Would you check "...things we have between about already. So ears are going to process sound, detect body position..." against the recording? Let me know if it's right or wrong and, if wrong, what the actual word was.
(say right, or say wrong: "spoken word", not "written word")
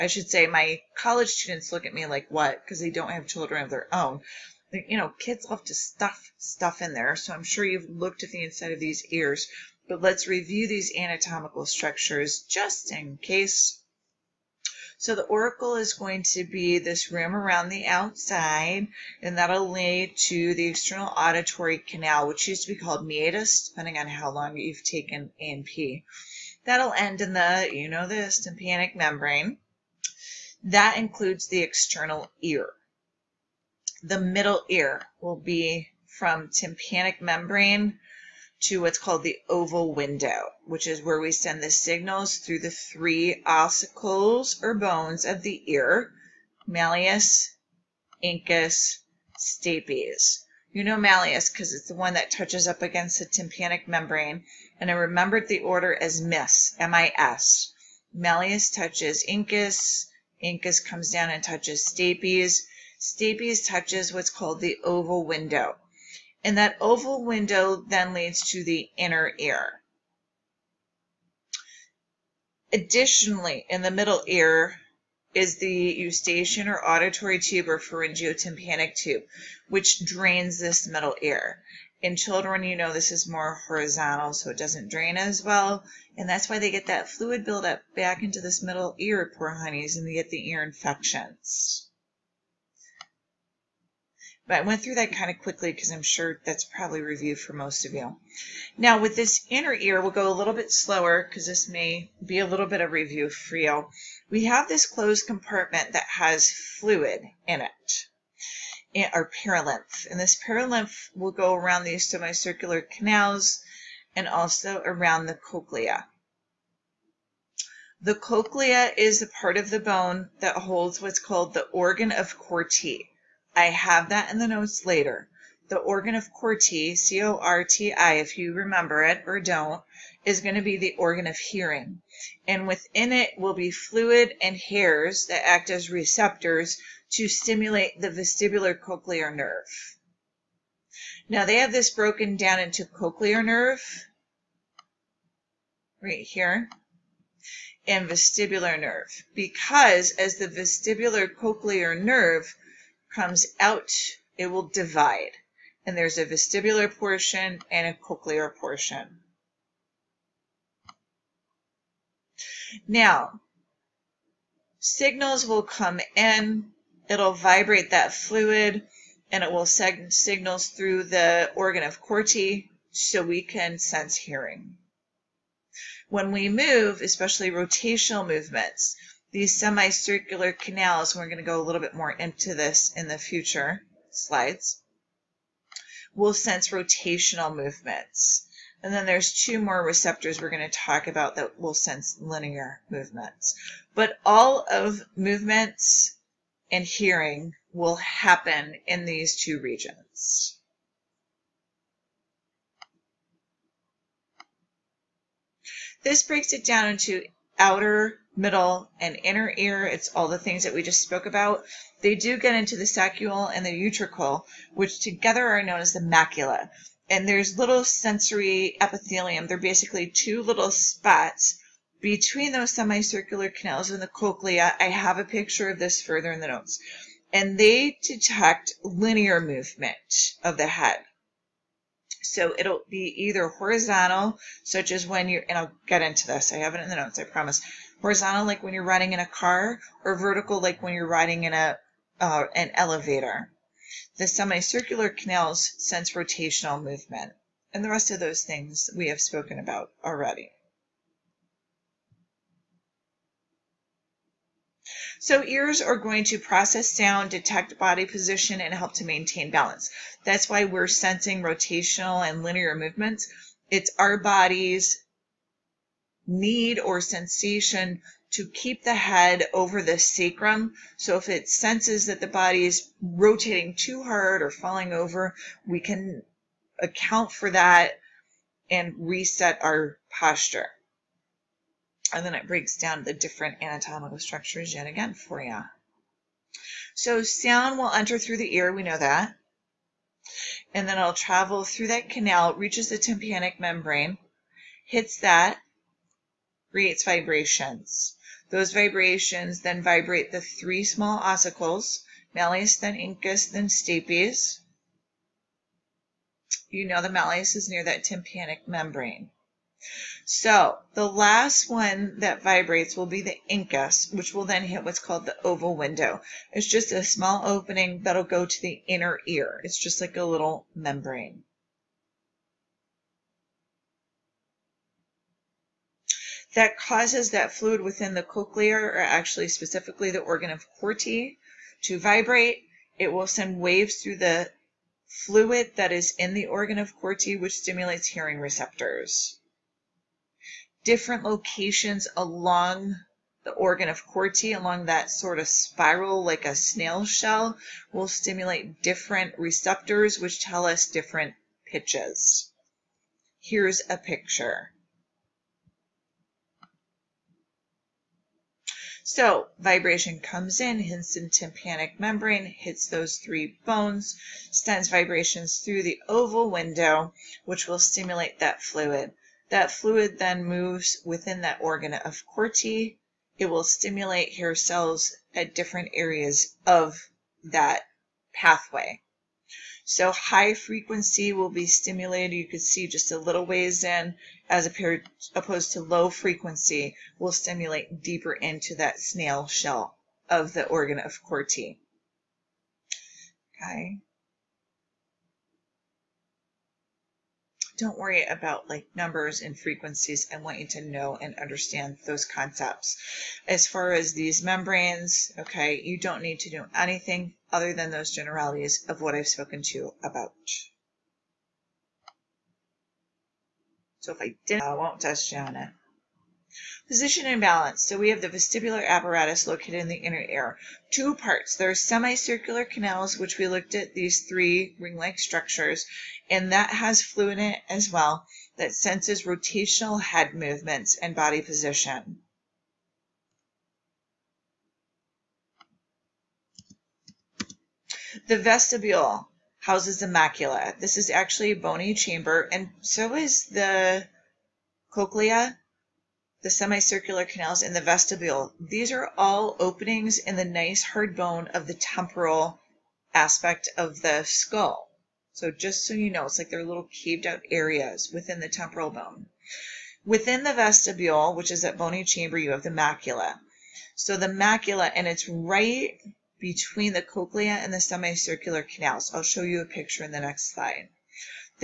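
wrong: "spoken", not "between".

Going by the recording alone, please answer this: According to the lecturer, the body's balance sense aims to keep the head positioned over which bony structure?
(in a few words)
sacrum.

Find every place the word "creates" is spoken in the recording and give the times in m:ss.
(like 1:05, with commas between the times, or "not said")
4:56.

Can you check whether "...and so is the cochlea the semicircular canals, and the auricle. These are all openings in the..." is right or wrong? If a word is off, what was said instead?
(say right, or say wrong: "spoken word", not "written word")
wrong: "vestibule", not "auricle".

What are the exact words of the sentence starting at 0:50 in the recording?
You know malleus because it's the one that touches up against the tympanic membrane, and I remembered the order as MIS, M-I-S.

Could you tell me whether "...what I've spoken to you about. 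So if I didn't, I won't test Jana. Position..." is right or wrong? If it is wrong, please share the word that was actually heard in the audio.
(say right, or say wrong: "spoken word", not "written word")
right.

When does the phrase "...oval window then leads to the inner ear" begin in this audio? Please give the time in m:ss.
1:06.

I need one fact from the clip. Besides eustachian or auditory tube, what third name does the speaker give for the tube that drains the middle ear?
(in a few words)
pharyngeotympanic tube.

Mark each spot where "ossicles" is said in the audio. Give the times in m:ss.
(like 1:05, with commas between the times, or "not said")
0:43, 5:01.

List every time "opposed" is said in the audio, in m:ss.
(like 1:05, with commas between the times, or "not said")
6:25.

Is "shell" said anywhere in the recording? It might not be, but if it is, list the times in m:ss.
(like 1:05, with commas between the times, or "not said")
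5:47, 6:29.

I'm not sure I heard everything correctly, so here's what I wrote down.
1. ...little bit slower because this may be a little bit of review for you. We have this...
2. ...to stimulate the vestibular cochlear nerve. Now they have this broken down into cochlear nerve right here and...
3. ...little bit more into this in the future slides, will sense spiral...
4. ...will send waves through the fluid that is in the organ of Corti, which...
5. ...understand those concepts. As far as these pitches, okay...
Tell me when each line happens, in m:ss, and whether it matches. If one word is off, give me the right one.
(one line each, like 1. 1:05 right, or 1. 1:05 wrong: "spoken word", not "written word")
1. 1:40 right
2. 2:17 right
3. 3:01 wrong: "rotational", not "spiral"
4. 5:33 right
5. 6:41 wrong: "membranes", not "pitches".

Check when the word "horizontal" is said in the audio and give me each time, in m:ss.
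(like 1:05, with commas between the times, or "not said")
1:23, 3:53, 3:58.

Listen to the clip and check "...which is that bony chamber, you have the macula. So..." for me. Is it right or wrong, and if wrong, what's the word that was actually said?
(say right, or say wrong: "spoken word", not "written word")
right.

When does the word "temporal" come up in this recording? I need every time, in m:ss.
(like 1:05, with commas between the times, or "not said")
7:31, 7:38.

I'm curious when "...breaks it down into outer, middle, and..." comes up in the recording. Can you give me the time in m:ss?
3:26.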